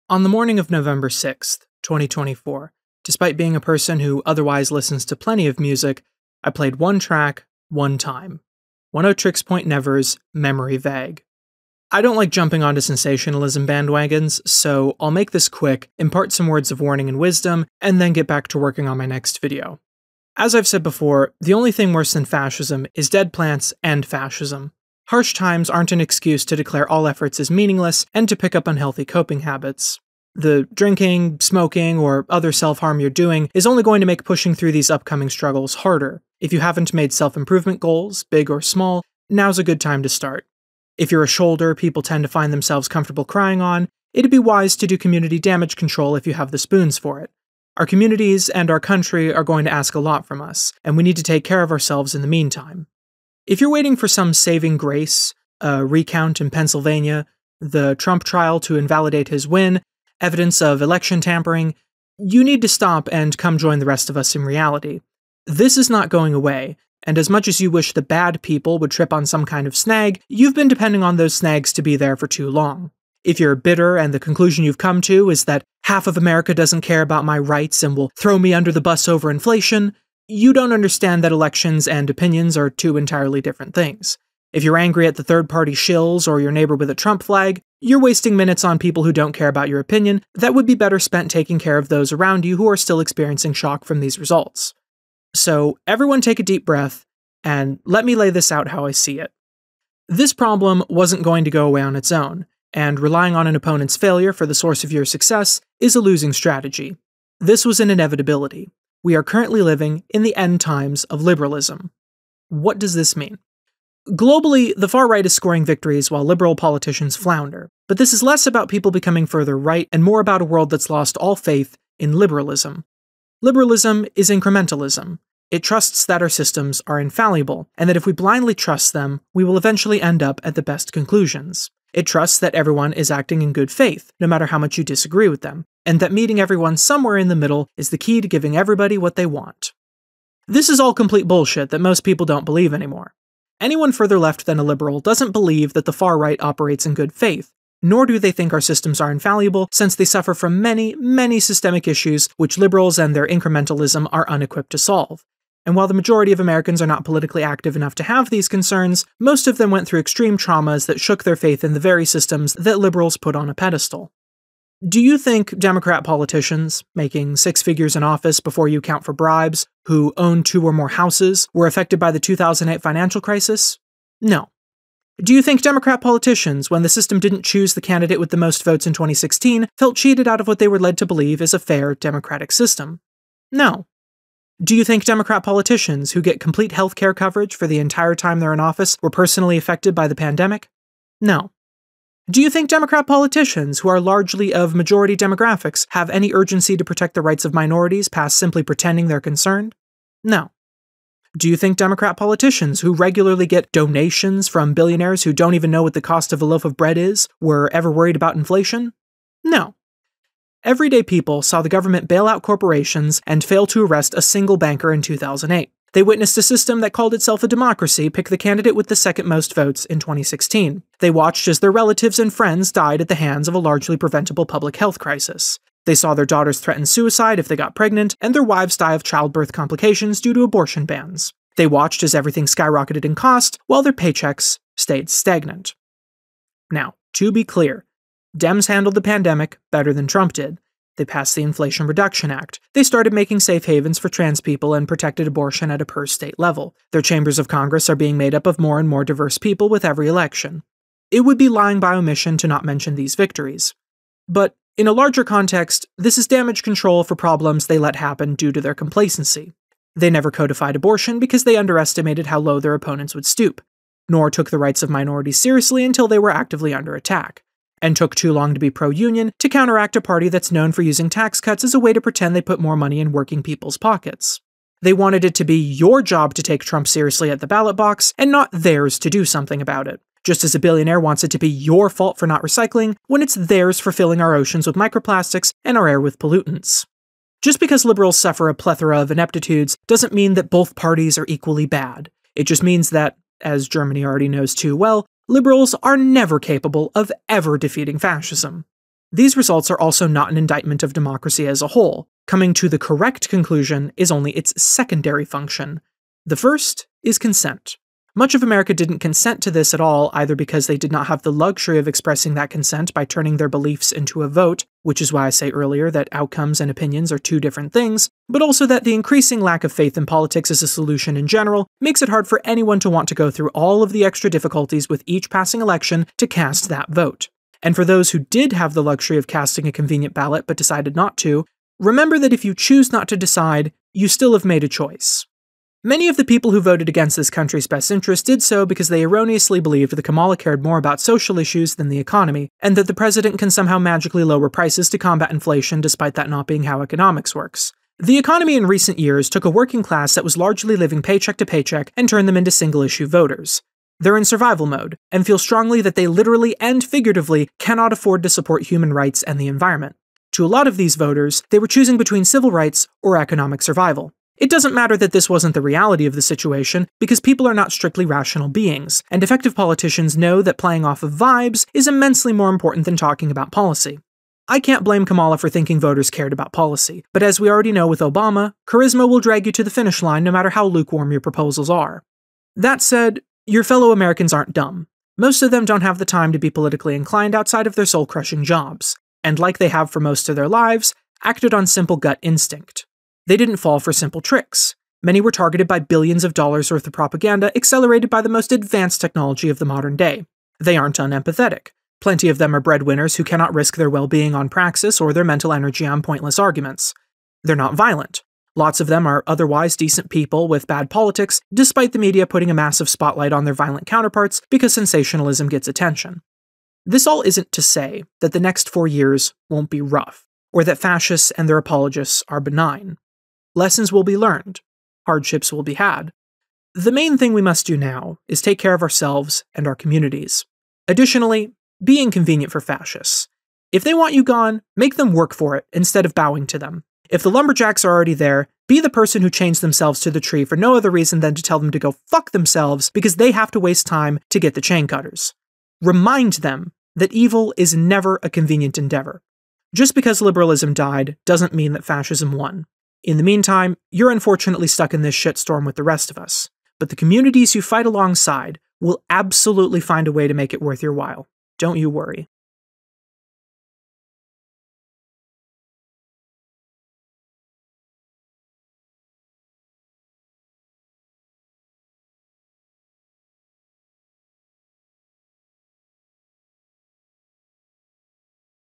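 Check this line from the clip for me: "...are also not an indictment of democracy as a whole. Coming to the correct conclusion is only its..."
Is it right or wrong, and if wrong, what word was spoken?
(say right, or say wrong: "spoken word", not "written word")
right.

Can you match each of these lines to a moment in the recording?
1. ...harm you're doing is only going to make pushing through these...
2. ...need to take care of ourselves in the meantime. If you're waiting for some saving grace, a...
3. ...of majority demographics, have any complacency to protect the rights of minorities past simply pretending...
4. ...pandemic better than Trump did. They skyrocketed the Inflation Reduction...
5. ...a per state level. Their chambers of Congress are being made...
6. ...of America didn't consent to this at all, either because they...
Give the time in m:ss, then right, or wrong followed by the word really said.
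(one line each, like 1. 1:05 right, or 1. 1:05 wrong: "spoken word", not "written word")
1. 0:32 right
2. 0:51 right
3. 3:14 wrong: "urgency", not "complacency"
4. 3:59 wrong: "passed", not "skyrocketed"
5. 4:05 right
6. 5:08 right.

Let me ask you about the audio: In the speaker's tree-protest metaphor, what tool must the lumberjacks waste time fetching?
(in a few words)
Chain cutters.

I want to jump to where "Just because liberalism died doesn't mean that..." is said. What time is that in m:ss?
7:29.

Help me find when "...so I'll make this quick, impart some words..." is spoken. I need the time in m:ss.
0:14.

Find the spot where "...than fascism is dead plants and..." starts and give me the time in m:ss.
0:22.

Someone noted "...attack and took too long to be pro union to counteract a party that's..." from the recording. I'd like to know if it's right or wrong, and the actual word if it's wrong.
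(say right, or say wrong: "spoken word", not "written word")
right.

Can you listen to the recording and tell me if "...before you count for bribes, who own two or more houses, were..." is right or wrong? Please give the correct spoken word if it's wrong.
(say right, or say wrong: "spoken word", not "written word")
right.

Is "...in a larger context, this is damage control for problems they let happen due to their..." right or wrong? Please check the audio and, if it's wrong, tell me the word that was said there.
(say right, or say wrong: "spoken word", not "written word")
right.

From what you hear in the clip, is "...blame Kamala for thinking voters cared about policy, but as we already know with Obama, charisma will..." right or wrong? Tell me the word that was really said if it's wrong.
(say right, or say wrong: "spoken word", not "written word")
right.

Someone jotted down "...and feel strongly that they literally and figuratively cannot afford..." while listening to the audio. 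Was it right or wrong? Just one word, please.
right.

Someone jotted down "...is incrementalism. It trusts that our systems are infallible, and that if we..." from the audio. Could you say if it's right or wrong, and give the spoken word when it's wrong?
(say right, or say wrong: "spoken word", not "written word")
right.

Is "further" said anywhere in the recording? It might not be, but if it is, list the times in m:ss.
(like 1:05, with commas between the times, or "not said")
1:59, 2:23.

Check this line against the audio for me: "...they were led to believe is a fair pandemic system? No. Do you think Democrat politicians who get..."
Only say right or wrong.
wrong.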